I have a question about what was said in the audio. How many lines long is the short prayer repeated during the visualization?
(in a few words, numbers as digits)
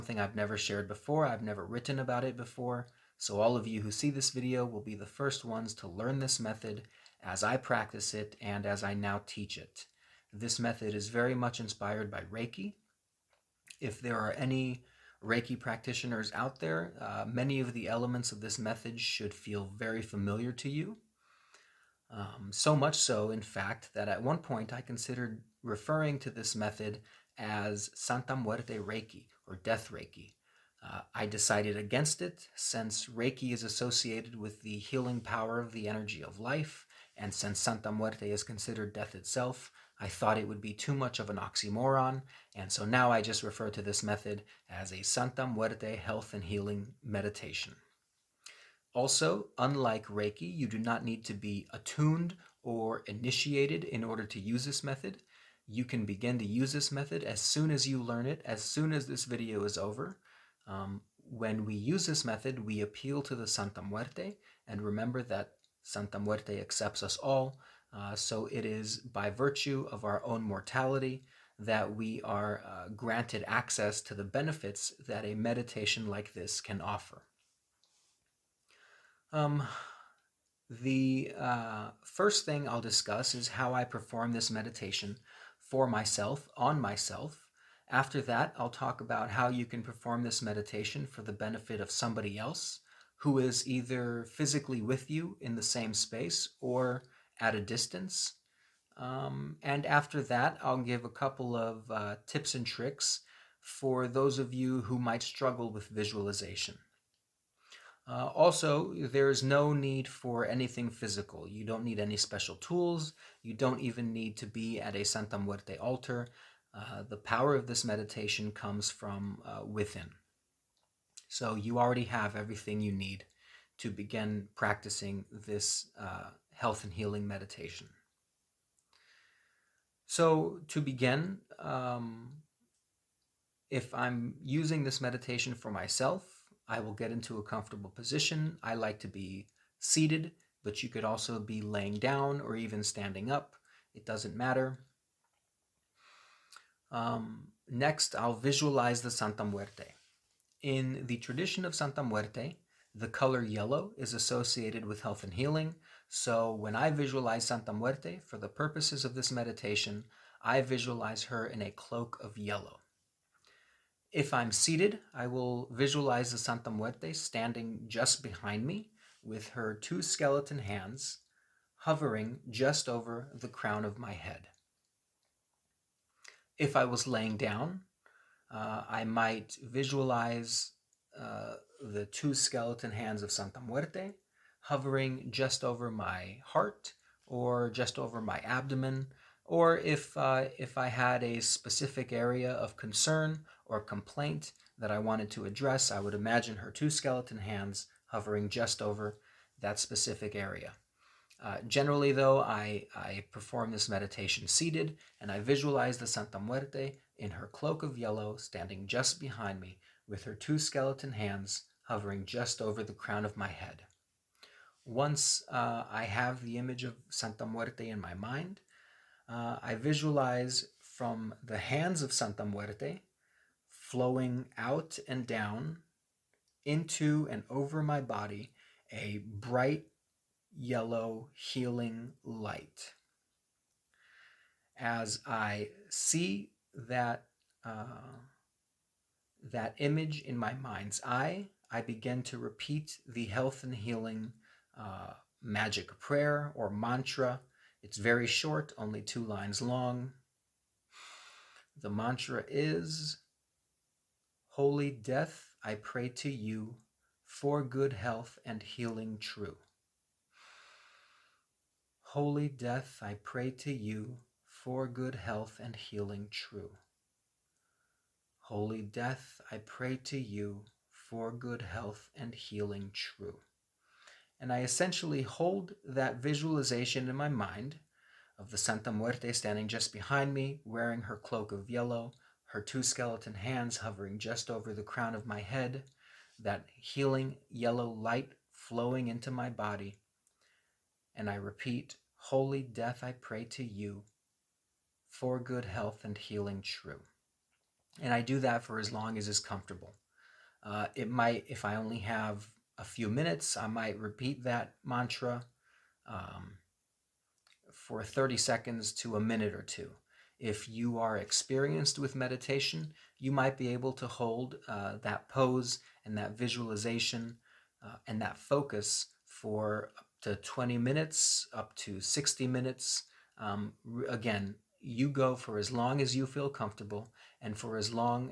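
2.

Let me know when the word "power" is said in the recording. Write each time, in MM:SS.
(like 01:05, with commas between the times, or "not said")
00:35, 01:57.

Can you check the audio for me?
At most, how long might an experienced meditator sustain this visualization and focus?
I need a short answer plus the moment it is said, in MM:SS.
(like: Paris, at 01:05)
60 minutes, at 05:21.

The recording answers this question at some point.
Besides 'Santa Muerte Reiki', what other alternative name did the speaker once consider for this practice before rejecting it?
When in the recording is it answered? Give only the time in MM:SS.
00:29.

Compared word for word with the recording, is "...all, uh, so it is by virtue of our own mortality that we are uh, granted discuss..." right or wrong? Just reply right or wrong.
wrong.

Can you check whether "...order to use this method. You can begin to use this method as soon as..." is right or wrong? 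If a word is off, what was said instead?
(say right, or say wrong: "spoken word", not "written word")
right.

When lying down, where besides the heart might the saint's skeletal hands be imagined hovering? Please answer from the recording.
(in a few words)
abdomen.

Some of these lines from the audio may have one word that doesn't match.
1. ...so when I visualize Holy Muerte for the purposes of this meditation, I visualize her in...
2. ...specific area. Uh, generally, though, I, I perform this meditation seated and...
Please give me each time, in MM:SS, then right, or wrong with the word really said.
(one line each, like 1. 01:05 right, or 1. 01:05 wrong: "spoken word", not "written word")
1. 02:36 wrong: "Santa", not "Holy"
2. 03:19 right.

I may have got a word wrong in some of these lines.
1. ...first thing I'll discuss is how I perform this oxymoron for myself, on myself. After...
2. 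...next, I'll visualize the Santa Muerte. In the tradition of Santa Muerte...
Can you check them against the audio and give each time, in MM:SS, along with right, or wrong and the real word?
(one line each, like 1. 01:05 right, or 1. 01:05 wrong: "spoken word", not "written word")
1. 01:22 wrong: "meditation", not "oxymoron"
2. 02:27 right.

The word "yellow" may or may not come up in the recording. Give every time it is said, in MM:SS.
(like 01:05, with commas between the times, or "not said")
02:33, 02:42, 03:27, 03:50, 04:41, 04:47.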